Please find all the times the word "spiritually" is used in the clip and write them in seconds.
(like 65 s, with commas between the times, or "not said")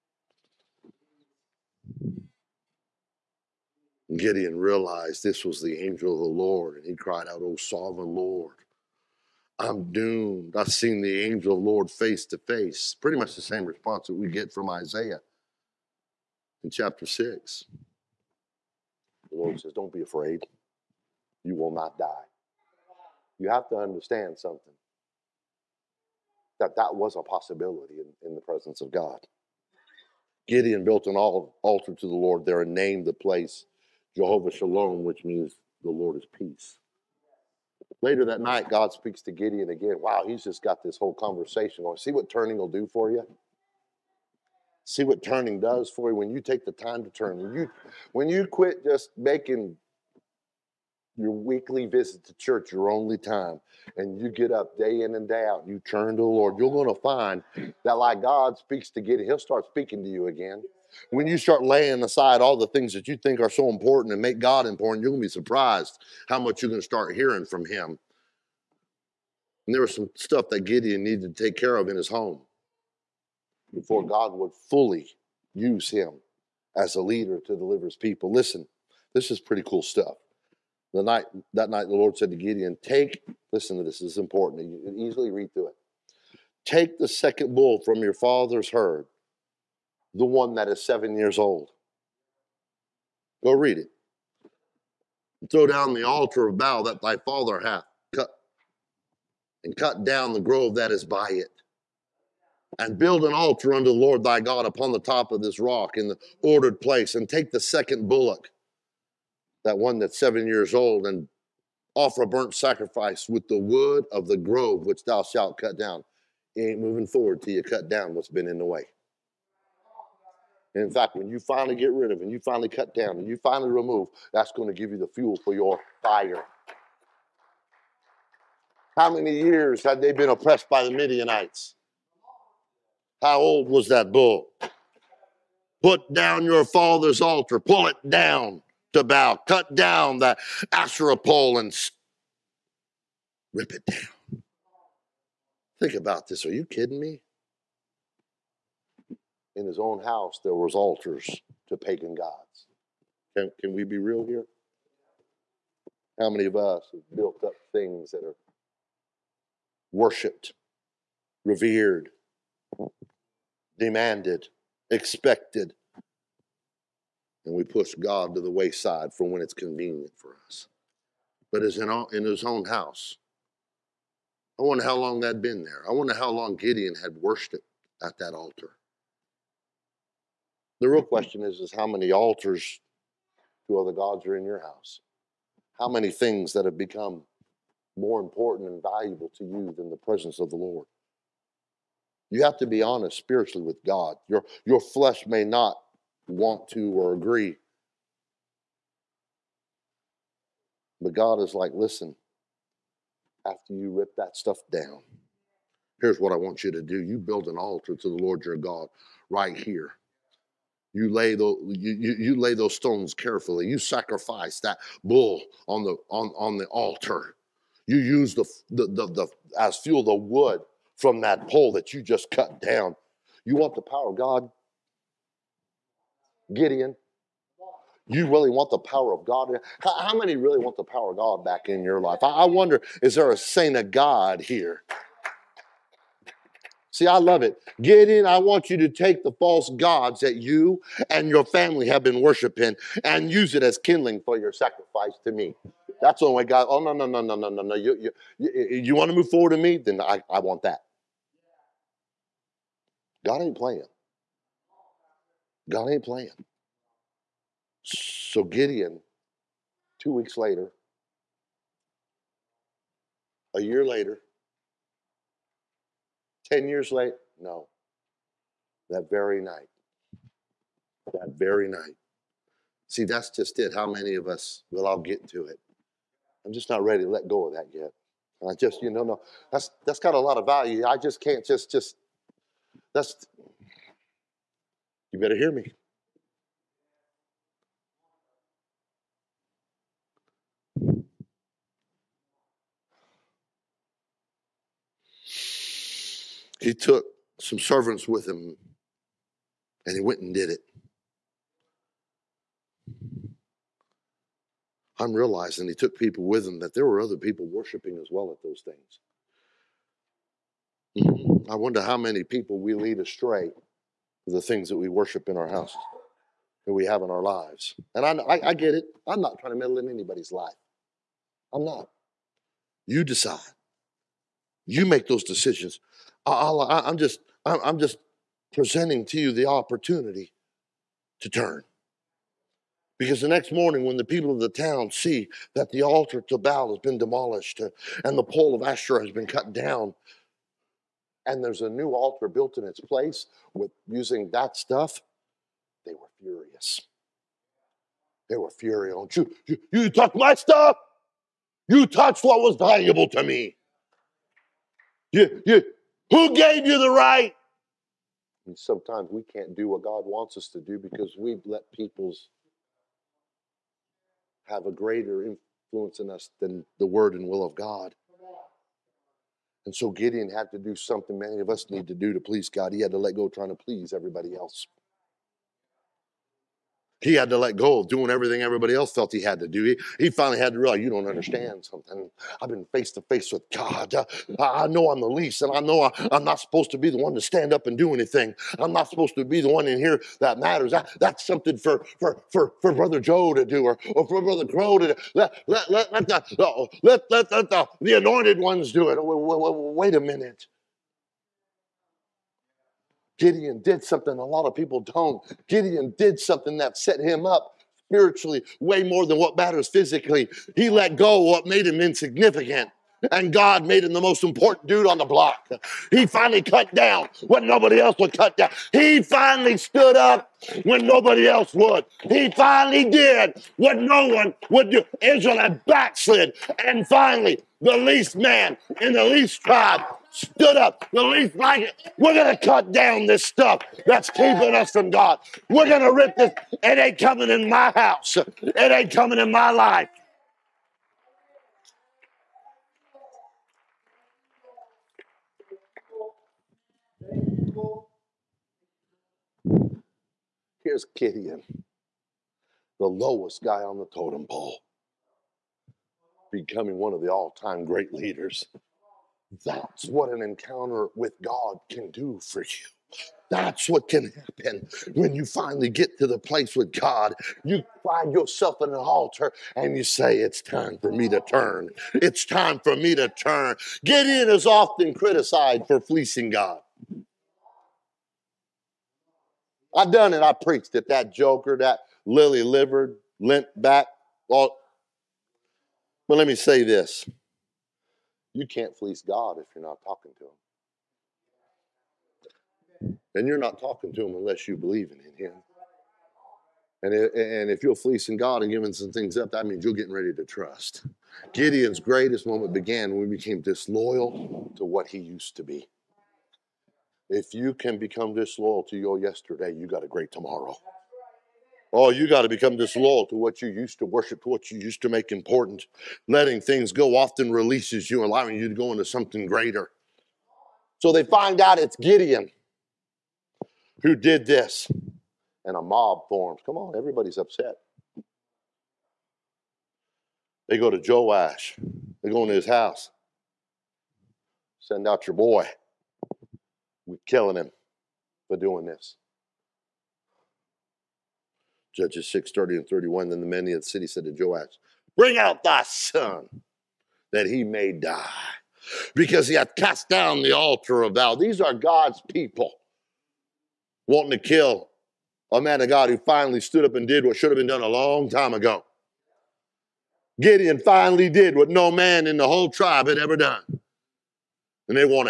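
193 s, 407 s.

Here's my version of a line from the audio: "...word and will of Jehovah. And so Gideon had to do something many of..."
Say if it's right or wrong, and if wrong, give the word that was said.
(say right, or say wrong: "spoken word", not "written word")
wrong: "God", not "Jehovah".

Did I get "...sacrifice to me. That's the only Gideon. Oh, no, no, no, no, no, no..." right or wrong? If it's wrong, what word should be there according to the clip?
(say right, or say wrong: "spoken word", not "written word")
wrong: "God", not "Gideon".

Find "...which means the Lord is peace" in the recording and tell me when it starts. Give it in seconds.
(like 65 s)
35 s.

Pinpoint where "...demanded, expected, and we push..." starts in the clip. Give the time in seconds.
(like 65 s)
163 s.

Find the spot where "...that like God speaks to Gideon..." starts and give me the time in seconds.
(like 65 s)
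57 s.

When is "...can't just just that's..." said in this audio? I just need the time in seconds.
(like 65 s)
281 s.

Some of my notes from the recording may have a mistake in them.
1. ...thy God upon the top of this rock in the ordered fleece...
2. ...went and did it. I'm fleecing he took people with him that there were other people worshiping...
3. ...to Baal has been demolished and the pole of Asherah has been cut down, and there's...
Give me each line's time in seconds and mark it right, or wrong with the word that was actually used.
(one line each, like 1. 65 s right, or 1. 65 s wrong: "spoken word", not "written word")
1. 104 s wrong: "place", not "fleece"
2. 300 s wrong: "realizing", not "fleecing"
3. 336 s right.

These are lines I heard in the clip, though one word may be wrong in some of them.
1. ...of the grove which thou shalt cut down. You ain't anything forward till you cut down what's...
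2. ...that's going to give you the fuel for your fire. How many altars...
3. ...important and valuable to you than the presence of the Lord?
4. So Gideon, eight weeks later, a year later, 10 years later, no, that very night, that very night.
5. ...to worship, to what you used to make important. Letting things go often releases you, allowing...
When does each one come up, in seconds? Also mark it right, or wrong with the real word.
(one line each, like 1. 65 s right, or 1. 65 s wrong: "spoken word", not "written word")
1. 114 s wrong: "moving", not "anything"
2. 124 s wrong: "years", not "altars"
3. 188 s right
4. 257 s wrong: "two", not "eight"
5. 513 s right.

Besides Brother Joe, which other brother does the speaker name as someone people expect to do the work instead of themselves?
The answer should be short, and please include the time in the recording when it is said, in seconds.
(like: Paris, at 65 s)
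Brother Crow, at 394 s.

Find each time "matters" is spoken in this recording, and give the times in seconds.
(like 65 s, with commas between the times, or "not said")
390 s, 409 s.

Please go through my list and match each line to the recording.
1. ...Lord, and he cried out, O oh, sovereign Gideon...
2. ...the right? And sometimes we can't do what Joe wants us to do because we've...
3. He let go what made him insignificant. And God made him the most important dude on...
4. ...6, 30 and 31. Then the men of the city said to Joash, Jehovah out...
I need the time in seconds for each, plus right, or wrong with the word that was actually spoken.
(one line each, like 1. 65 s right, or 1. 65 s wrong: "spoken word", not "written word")
1. 6 s wrong: "Lord", not "Gideon"
2. 356 s wrong: "God", not "Joe"
3. 410 s right
4. 542 s wrong: "Bring", not "Jehovah".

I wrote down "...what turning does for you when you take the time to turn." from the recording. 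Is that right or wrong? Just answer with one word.
right.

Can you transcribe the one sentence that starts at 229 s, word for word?
How, many really want the power of God back in your life?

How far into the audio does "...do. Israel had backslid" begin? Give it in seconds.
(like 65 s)
424 s.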